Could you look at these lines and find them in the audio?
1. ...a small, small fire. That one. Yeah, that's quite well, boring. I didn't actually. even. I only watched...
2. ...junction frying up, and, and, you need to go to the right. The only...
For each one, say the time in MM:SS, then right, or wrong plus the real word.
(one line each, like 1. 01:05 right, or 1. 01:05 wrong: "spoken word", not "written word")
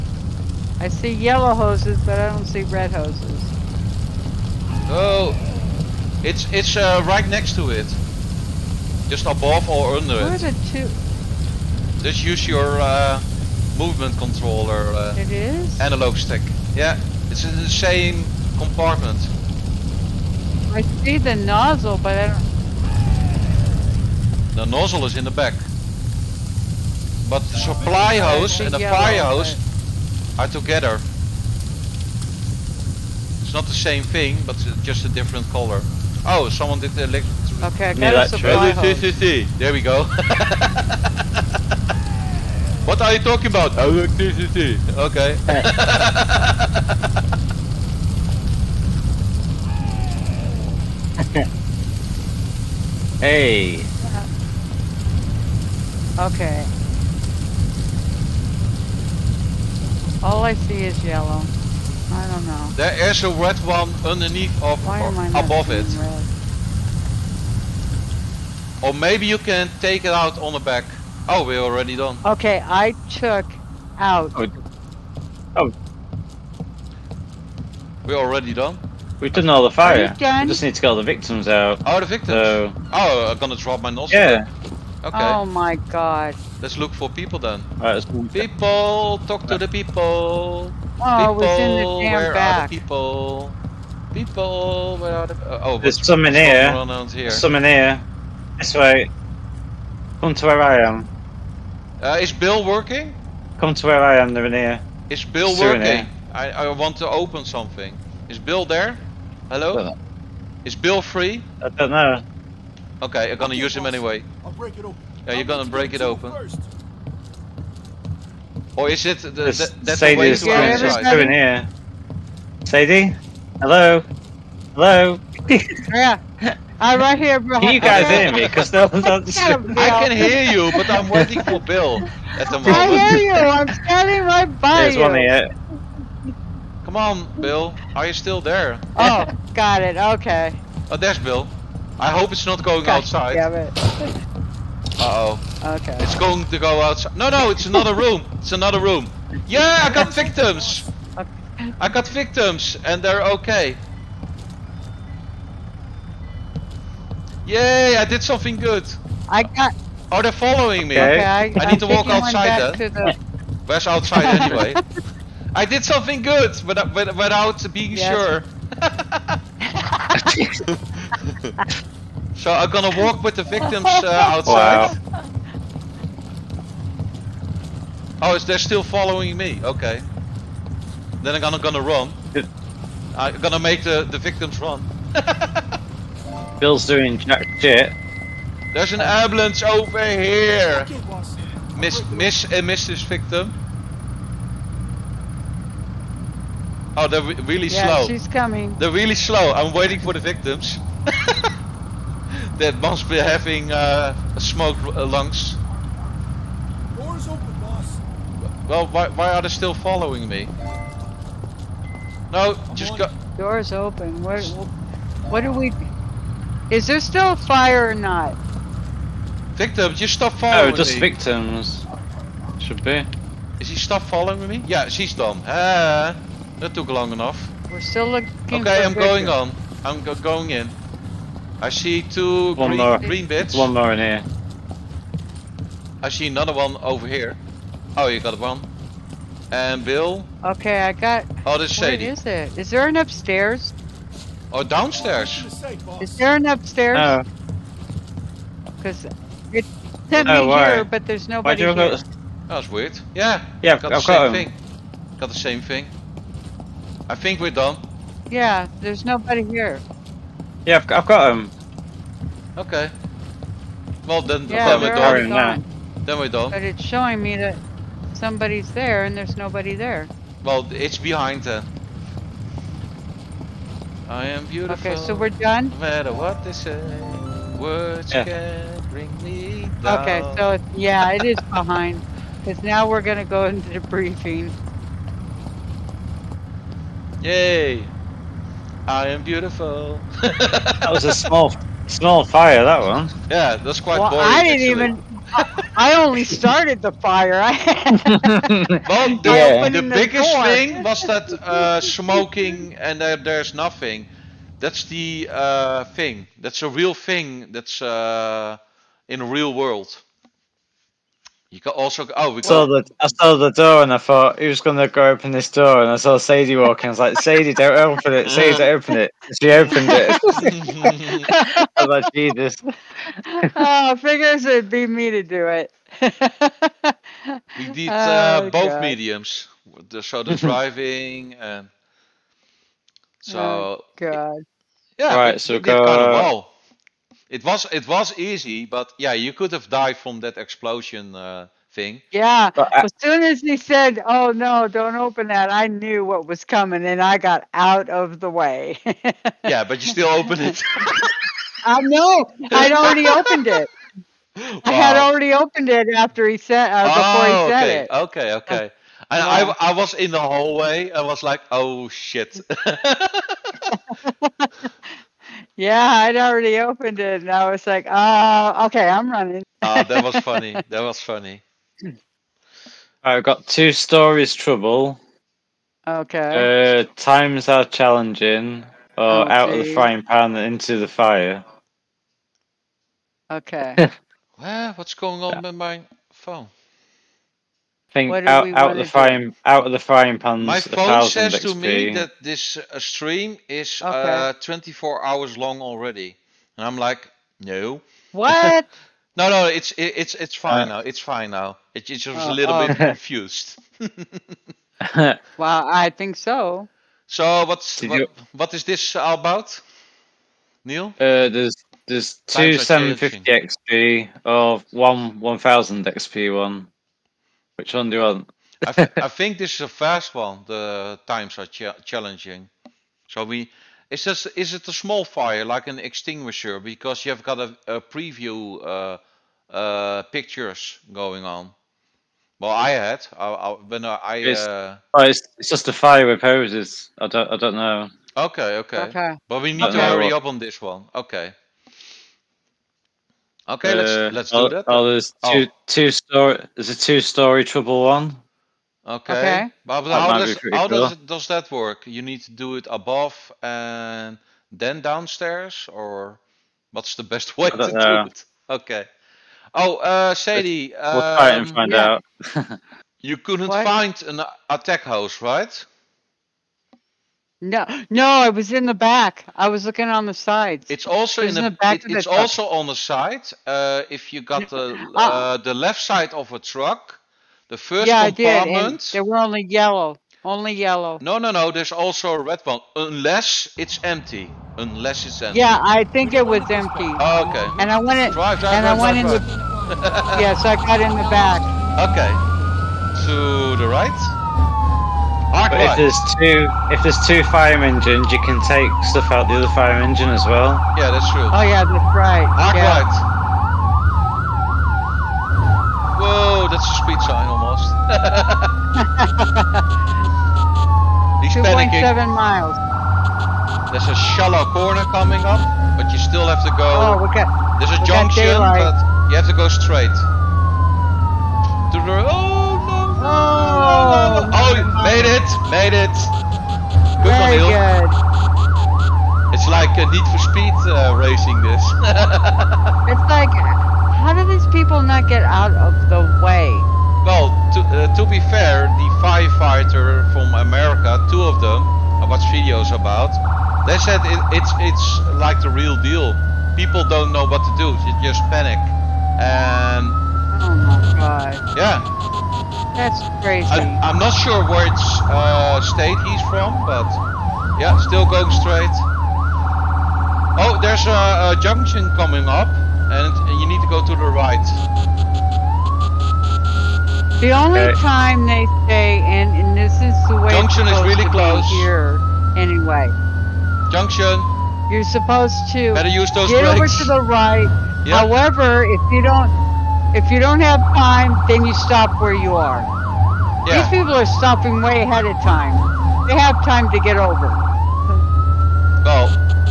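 1. 04:51 wrong: "started", not "watched"
2. 09:21 wrong: "coming", not "frying".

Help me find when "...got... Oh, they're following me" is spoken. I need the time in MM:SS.
02:39.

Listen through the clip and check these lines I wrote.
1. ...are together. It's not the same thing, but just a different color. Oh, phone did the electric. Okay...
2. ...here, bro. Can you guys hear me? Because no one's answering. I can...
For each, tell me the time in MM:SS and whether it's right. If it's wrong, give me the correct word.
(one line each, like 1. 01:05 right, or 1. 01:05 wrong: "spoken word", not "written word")
1. 00:30 wrong: "someone", not "phone"
2. 02:07 right.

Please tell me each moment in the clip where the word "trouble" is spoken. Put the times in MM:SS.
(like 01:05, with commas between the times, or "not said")
06:14.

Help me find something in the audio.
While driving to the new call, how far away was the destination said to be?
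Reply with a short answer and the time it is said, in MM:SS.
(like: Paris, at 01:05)
2.7 miles, at 08:31.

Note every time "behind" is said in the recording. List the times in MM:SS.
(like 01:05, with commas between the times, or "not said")
04:30, 04:41.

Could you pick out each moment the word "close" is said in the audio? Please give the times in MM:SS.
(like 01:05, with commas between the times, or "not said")
09:31.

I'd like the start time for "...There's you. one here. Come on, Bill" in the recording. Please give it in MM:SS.
02:14.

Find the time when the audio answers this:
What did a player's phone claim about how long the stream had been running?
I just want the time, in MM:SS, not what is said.
06:34.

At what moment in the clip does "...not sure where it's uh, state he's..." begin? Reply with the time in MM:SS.
09:13.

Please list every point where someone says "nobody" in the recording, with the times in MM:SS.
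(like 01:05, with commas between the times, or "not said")
04:11, 04:19, 04:29.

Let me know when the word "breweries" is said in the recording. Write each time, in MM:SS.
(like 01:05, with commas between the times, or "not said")
not said.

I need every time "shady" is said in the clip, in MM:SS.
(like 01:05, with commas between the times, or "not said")
04:01.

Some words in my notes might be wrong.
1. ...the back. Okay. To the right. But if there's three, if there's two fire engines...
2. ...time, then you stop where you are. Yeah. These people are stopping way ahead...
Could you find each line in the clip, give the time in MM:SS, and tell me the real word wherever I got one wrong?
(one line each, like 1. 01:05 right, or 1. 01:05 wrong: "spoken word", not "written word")
1. 08:10 wrong: "two", not "three"
2. 09:40 right.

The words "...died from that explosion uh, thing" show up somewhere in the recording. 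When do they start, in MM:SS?
05:39.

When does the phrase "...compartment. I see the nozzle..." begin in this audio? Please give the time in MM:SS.
00:18.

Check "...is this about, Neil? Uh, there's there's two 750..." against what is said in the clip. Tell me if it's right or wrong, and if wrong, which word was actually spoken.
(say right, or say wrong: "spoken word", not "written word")
right.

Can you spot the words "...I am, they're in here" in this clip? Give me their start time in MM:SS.
01:44.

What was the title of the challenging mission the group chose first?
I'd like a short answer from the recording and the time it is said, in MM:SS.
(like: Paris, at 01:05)
The times are challenging, at 07:00.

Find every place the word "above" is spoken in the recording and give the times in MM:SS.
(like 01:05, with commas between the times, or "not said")
00:09, 01:05, 07:32.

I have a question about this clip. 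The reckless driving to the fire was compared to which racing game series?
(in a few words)
Need for Speed.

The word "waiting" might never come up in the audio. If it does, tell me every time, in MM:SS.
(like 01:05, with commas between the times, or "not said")
02:11, 03:19.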